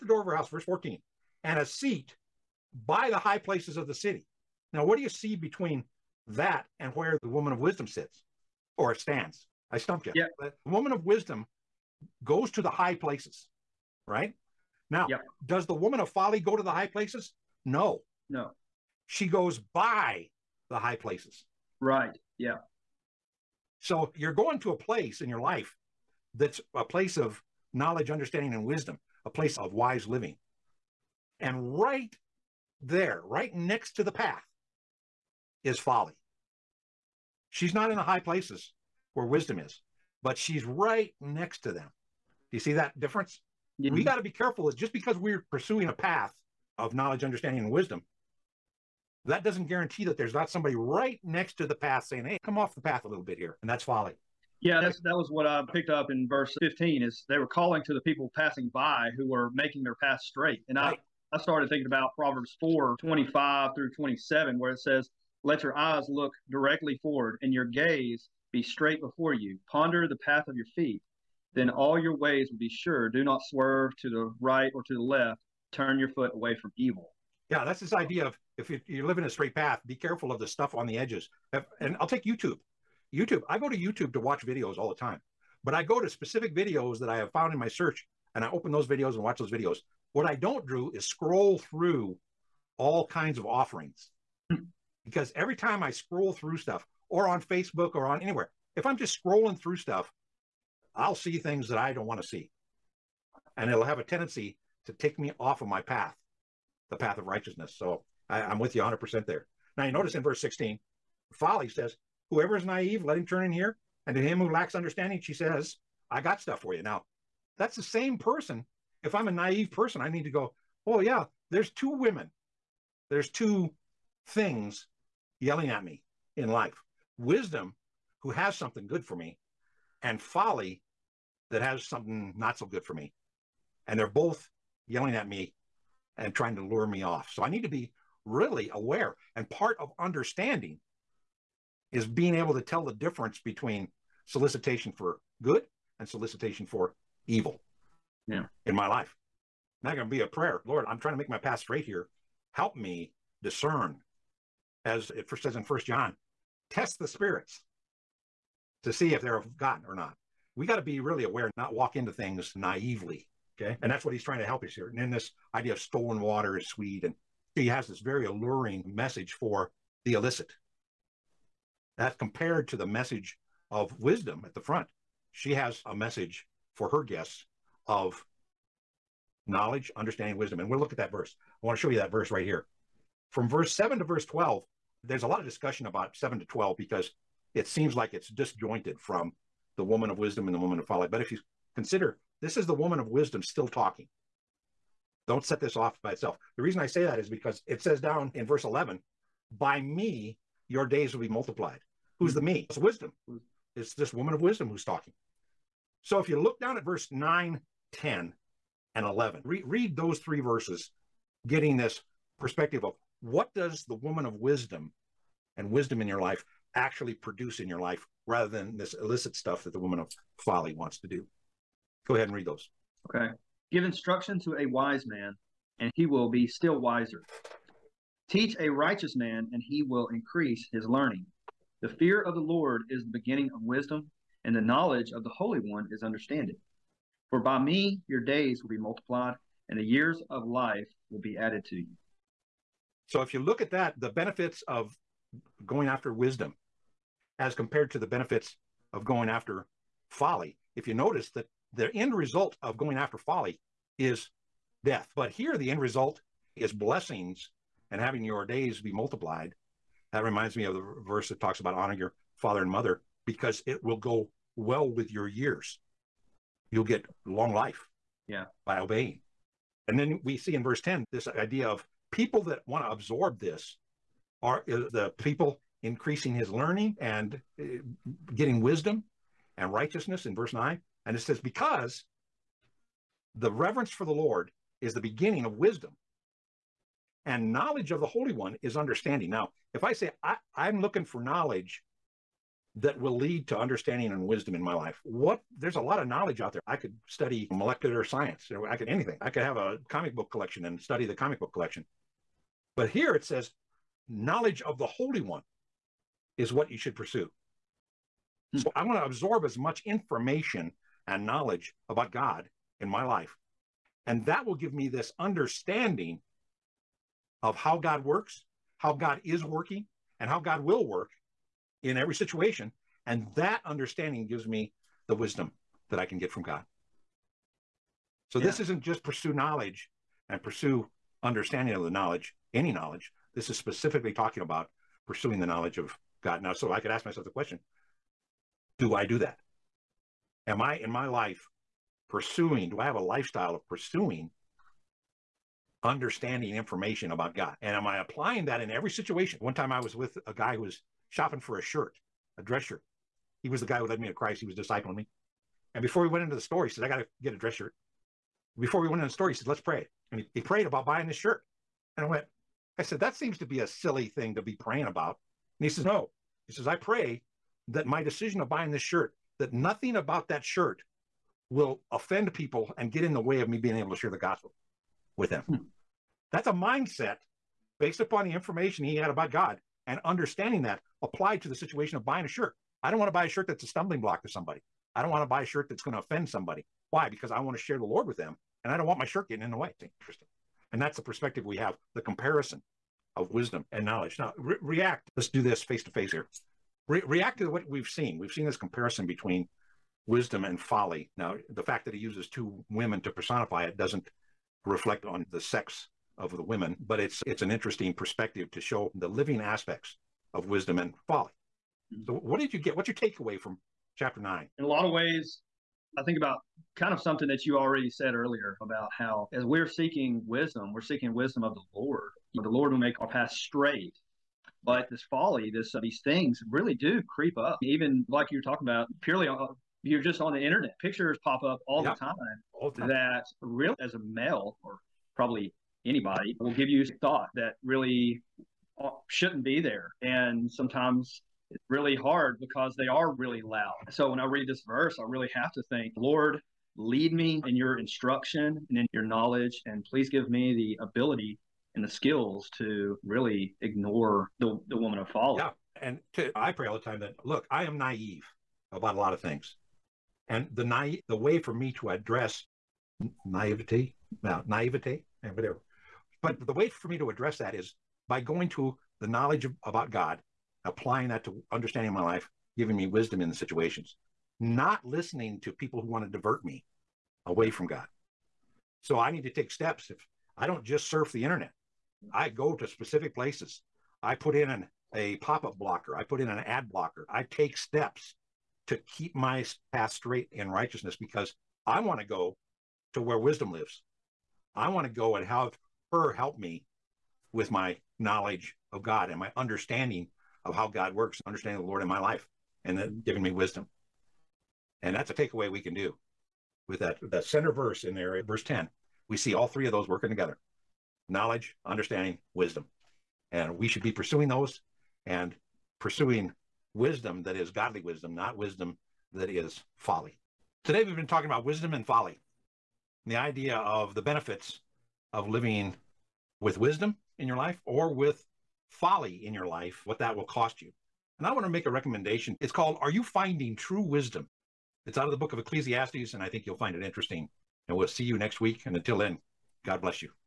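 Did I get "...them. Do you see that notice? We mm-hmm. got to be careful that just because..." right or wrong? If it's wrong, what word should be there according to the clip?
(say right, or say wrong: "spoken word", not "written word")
wrong: "difference", not "notice".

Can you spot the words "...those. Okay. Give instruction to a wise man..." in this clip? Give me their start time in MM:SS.
03:42.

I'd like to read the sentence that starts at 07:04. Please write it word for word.
But this folly, this uh, these things really do creep up.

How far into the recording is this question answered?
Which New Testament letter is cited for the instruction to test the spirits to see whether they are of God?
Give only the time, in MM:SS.
02:35.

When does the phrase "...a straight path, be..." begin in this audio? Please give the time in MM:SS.
01:19.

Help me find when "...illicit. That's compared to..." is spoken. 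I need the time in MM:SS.
02:50.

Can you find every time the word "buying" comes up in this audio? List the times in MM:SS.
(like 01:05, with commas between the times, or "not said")
06:00, 06:08, 06:22.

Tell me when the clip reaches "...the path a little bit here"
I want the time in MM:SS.
00:52.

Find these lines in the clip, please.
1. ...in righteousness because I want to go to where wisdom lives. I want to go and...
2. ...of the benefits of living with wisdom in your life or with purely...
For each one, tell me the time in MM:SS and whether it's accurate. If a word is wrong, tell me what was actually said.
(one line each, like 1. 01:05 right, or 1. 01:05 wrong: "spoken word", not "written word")
1. 08:10 right
2. 08:43 wrong: "folly", not "purely".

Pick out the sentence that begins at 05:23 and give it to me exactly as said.
And that understanding gives me the wisdom that I can get from God.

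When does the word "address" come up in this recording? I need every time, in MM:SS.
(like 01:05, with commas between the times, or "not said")
07:41, 07:47.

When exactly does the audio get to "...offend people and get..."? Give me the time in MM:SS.
06:11.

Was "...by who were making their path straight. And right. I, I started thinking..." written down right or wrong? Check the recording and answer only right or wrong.
right.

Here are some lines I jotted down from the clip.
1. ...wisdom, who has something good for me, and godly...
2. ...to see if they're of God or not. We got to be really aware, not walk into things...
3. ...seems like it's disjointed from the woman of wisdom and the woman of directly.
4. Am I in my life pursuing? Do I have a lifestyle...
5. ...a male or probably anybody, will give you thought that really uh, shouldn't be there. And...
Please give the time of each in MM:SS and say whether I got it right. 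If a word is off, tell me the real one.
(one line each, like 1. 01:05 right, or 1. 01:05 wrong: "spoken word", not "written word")
1. 02:07 wrong: "folly", not "godly"
2. 02:38 right
3. 03:07 wrong: "folly", not "directly"
4. 05:40 right
5. 07:13 right.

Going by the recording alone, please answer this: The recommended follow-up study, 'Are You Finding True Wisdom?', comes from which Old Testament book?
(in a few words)
Ecclesiastes.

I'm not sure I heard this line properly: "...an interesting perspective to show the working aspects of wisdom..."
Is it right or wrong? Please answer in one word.
wrong.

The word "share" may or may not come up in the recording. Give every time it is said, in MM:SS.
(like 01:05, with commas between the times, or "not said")
06:13, 06:27.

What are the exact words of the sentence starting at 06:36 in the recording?
Re- react to what we've seen.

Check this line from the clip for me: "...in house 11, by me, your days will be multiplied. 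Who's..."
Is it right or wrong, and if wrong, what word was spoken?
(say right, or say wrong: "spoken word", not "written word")
wrong: "verse", not "house".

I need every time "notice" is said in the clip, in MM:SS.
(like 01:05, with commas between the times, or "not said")
01:49, 04:10.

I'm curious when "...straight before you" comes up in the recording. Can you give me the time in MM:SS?
01:08.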